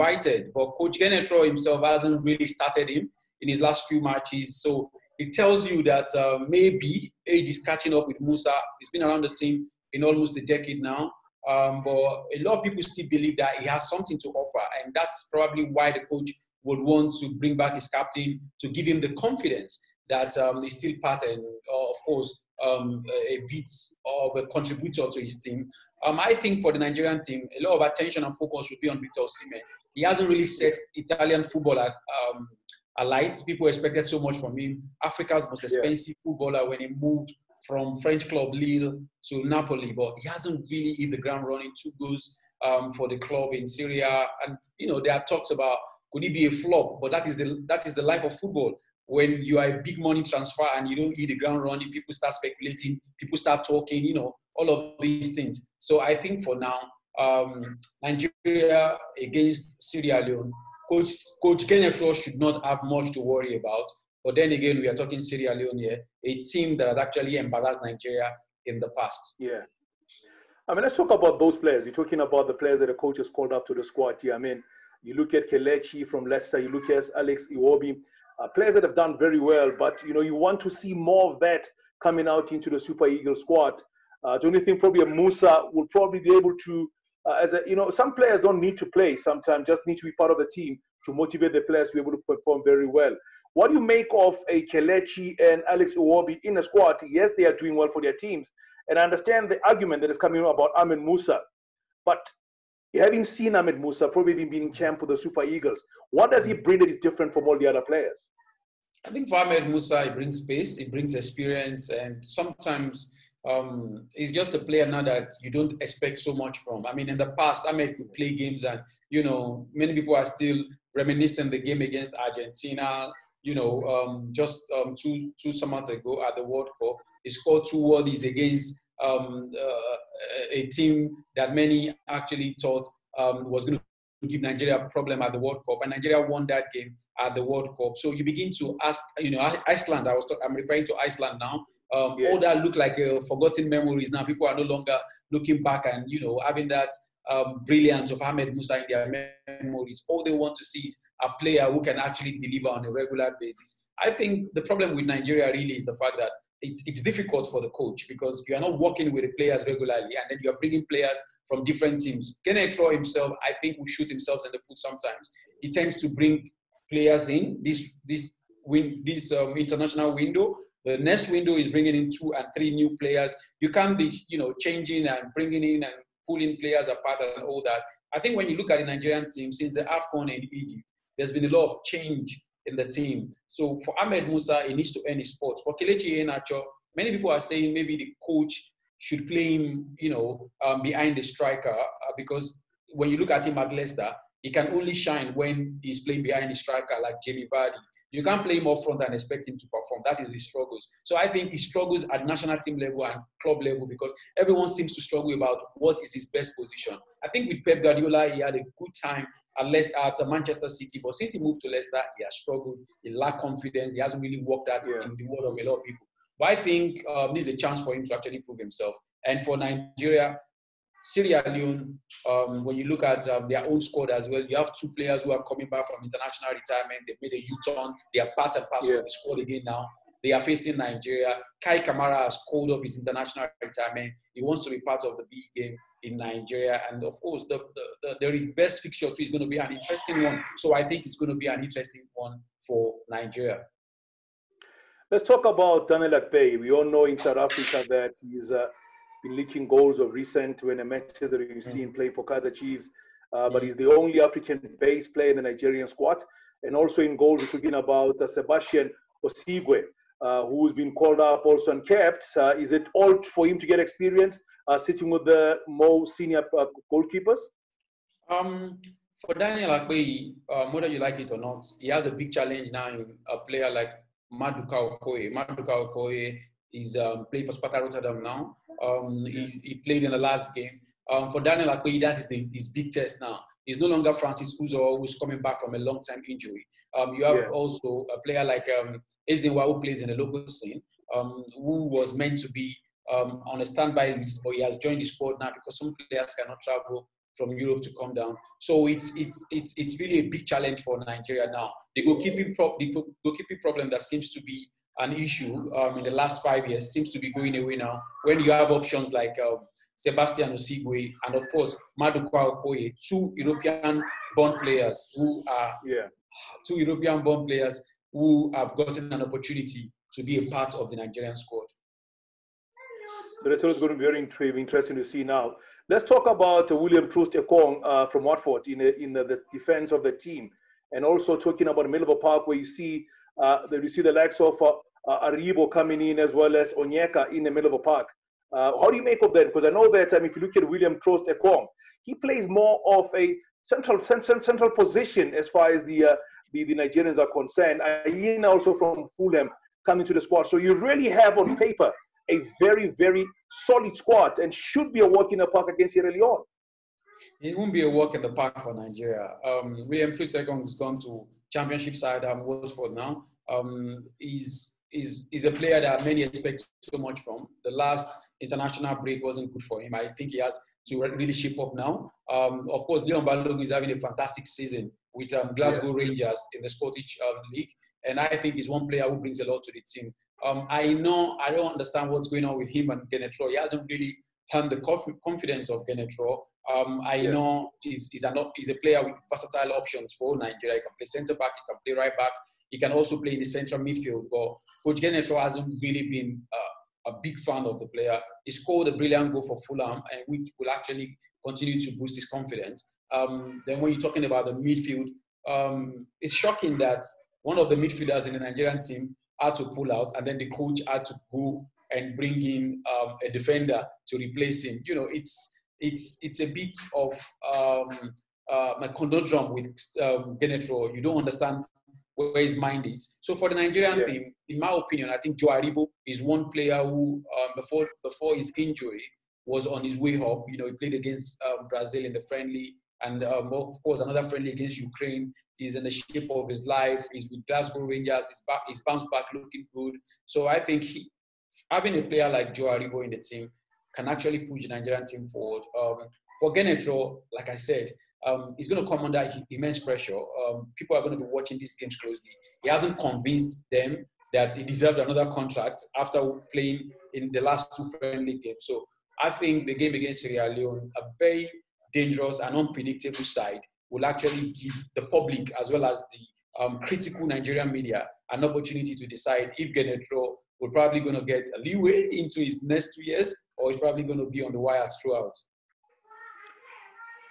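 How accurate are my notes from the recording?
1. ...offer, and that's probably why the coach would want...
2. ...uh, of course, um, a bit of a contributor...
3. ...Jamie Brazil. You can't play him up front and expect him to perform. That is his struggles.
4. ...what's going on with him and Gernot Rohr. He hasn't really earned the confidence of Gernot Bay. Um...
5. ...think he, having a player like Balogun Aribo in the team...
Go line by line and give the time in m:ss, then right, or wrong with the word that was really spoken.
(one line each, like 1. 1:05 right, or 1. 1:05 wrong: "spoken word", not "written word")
1. 0:14 right
2. 0:21 right
3. 3:17 wrong: "Vardy", not "Brazil"
4. 6:22 wrong: "Rohr", not "Bay"
5. 7:20 wrong: "Joe", not "Balogun".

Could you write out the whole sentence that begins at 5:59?
Um, William Troost Ekong has gone to Championship side um, Watford now.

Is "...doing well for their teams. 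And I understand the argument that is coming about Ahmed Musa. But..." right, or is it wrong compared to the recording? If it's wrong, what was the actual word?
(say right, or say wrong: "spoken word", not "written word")
right.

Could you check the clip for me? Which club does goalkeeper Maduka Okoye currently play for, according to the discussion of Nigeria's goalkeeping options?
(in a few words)
Sparta Rotterdam.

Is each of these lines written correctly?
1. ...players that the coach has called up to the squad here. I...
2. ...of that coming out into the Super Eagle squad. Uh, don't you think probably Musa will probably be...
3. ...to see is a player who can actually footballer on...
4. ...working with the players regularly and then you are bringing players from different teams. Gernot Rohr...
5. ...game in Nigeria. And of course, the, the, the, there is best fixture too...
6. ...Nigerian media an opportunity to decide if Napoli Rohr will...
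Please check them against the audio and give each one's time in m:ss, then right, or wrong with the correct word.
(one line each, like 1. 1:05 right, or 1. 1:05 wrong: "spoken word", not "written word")
1. 1:12 right
2. 1:21 right
3. 2:30 wrong: "deliver", not "footballer"
4. 2:38 right
5. 3:55 right
6. 7:47 wrong: "Gernot", not "Napoli".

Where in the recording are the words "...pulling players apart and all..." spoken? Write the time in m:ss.
2:56.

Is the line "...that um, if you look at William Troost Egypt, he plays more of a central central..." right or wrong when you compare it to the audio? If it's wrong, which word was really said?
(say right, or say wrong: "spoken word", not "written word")
wrong: "Ekong", not "Egypt".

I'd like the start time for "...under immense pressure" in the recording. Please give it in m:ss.
7:29.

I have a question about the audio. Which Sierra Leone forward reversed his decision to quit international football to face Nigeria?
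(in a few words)
Kai Kamara.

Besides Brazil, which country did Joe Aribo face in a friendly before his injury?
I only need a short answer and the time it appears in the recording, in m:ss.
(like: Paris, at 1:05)
Ukraine, at 7:14.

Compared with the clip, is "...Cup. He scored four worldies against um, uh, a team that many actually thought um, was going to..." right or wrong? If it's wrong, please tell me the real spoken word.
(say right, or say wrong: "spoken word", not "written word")
wrong: "two", not "four".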